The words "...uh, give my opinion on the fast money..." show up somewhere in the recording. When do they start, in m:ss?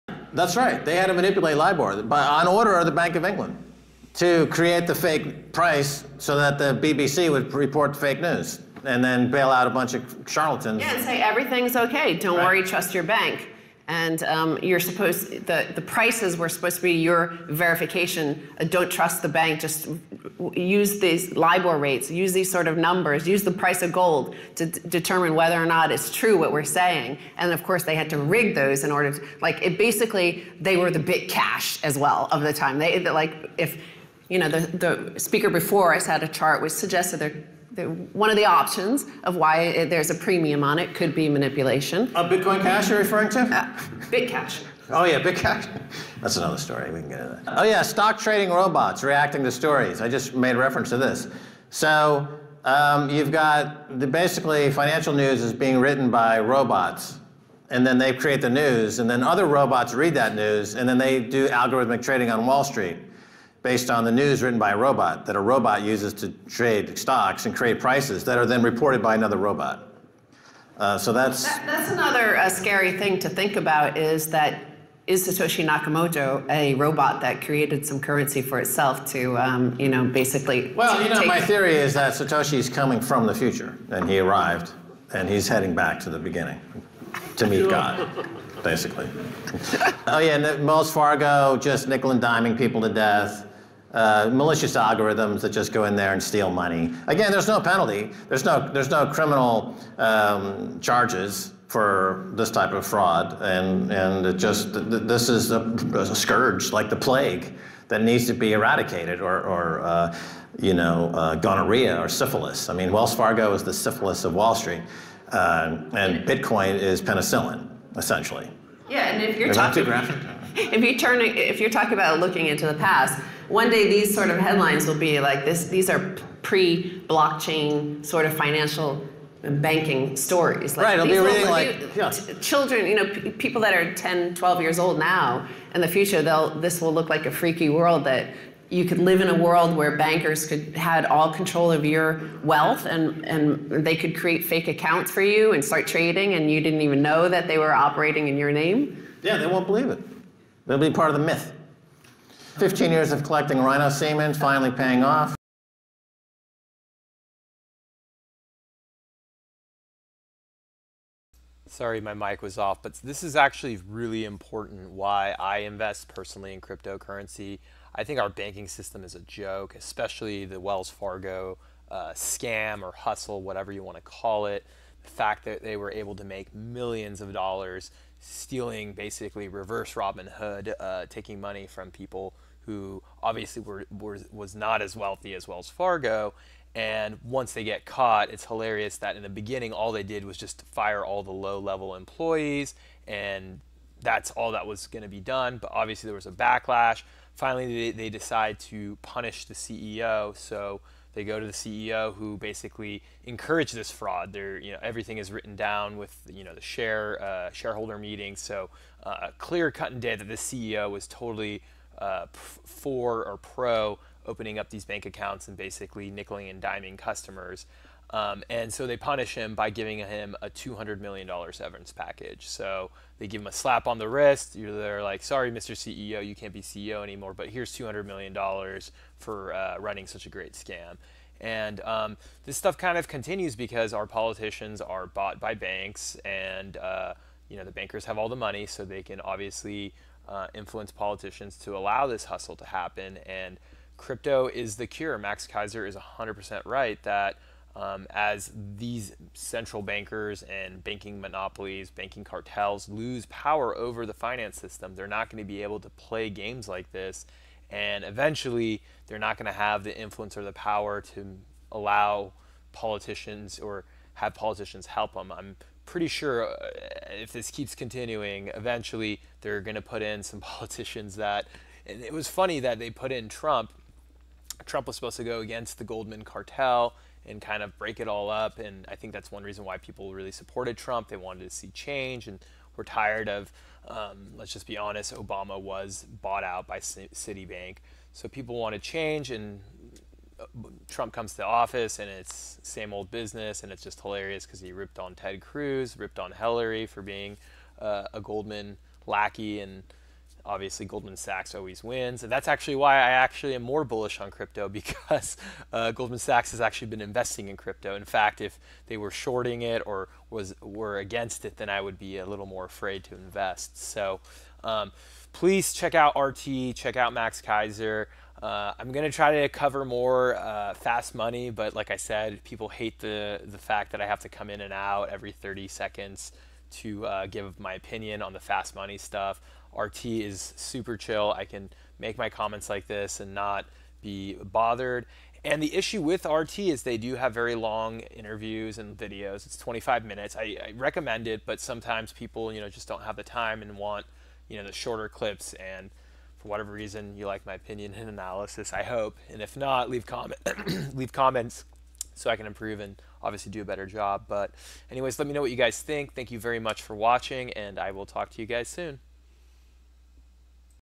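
5:27.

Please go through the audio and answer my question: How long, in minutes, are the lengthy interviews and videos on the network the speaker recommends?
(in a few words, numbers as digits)
25 minutes.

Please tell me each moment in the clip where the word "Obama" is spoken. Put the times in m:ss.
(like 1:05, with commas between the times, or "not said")
4:45.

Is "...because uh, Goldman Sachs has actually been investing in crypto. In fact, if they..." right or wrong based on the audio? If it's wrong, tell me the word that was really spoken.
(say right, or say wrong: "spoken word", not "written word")
right.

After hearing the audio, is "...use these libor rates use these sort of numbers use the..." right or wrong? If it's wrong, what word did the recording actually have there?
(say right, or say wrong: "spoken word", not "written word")
right.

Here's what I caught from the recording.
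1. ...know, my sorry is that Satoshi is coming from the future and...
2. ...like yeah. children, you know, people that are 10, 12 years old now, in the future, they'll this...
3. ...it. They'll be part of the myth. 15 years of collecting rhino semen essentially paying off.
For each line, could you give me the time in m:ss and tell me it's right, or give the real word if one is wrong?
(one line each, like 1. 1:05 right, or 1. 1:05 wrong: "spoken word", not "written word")
1. 1:21 wrong: "theory", not "sorry"
2. 2:11 right
3. 2:29 wrong: "finally", not "essentially".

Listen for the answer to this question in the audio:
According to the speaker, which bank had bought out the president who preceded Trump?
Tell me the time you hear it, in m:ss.
4:46.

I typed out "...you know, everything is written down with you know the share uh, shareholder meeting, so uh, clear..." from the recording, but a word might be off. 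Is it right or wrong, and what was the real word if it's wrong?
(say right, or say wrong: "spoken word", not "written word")
right.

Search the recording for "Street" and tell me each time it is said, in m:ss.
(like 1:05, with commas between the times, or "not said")
1:02, 1:54.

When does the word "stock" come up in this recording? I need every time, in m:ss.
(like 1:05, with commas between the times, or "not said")
0:47, 1:06.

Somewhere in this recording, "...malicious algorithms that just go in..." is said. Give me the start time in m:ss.
1:34.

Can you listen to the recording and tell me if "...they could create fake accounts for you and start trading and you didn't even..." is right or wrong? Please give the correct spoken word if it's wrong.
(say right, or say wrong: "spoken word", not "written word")
right.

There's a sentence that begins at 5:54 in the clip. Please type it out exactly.
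But anyways, let me know what you guys think.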